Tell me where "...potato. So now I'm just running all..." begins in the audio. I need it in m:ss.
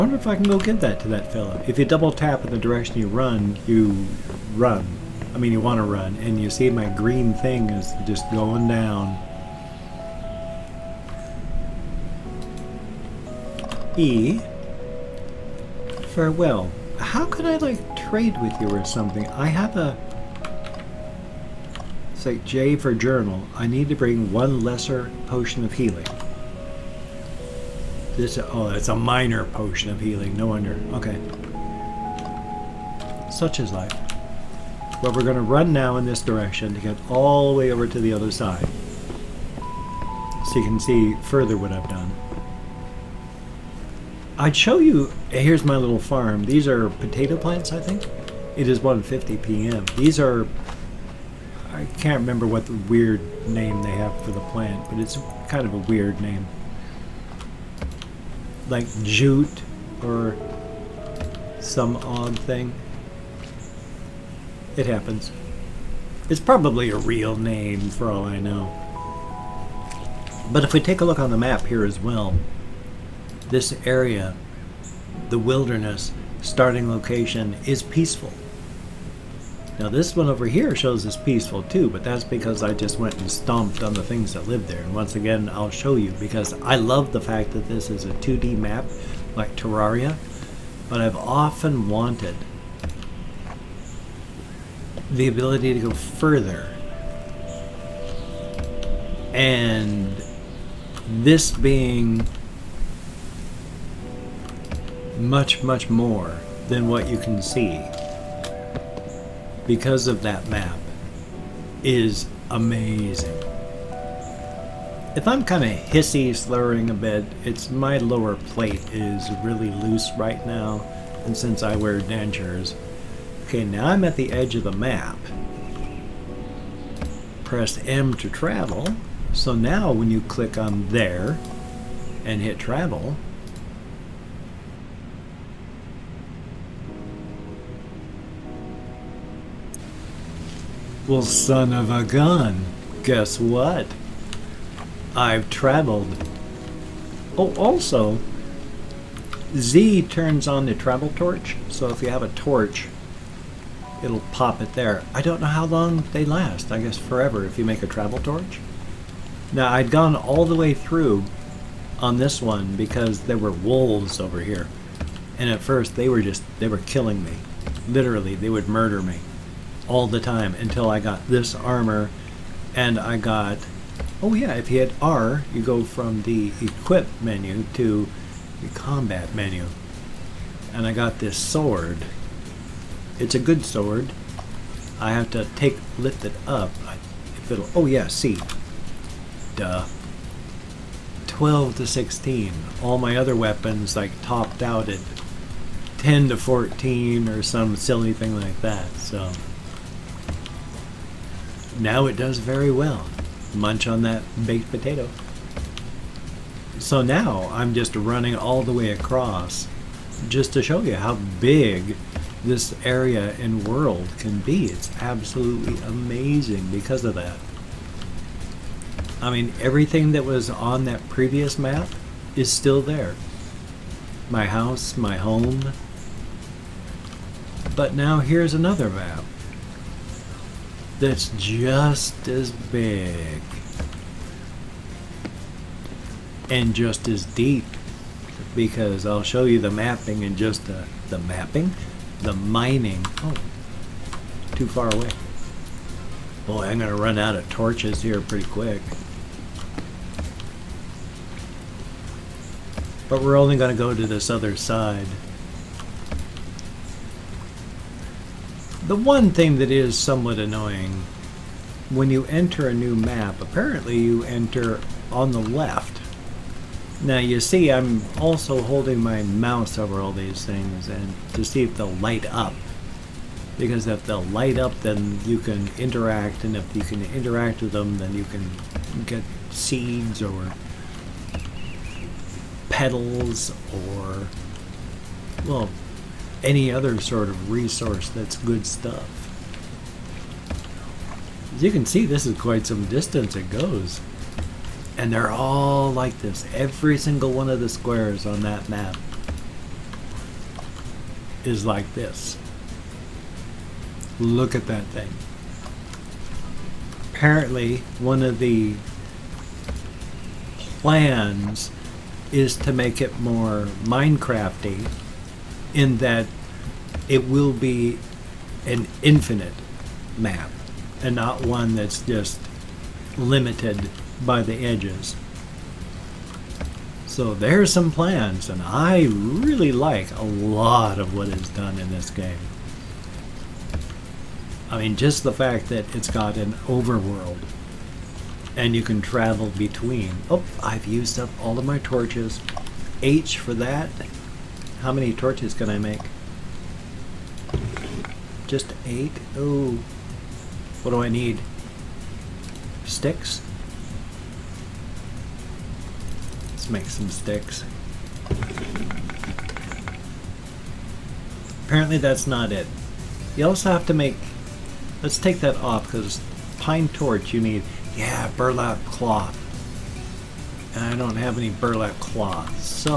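3:24.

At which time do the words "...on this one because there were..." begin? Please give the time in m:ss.
2:41.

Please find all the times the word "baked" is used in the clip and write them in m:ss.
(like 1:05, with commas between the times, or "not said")
3:24.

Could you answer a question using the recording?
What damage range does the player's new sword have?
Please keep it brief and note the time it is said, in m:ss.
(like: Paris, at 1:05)
12 to 16, at 3:11.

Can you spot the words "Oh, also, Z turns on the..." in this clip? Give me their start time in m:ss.
2:27.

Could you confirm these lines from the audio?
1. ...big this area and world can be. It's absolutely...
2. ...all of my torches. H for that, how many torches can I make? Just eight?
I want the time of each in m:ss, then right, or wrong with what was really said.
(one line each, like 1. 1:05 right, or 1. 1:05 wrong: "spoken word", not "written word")
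1. 3:31 right
2. 5:41 right.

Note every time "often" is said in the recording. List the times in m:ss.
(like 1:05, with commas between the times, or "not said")
1:31.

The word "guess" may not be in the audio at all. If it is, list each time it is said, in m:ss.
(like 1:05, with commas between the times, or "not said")
2:23, 2:36.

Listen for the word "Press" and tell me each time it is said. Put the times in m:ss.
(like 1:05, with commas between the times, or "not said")
2:07.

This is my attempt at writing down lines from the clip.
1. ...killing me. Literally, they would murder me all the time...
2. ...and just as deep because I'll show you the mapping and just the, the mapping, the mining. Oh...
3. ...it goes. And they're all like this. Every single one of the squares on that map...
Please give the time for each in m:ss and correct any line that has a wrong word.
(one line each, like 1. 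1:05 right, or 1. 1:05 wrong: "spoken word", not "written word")
1. 2:46 right
2. 3:56 right
3. 4:53 right.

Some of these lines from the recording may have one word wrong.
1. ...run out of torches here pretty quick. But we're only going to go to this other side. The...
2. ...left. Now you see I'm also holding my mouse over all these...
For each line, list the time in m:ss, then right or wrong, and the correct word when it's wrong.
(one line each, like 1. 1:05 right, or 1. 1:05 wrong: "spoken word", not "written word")
1. 4:06 right
2. 4:25 right.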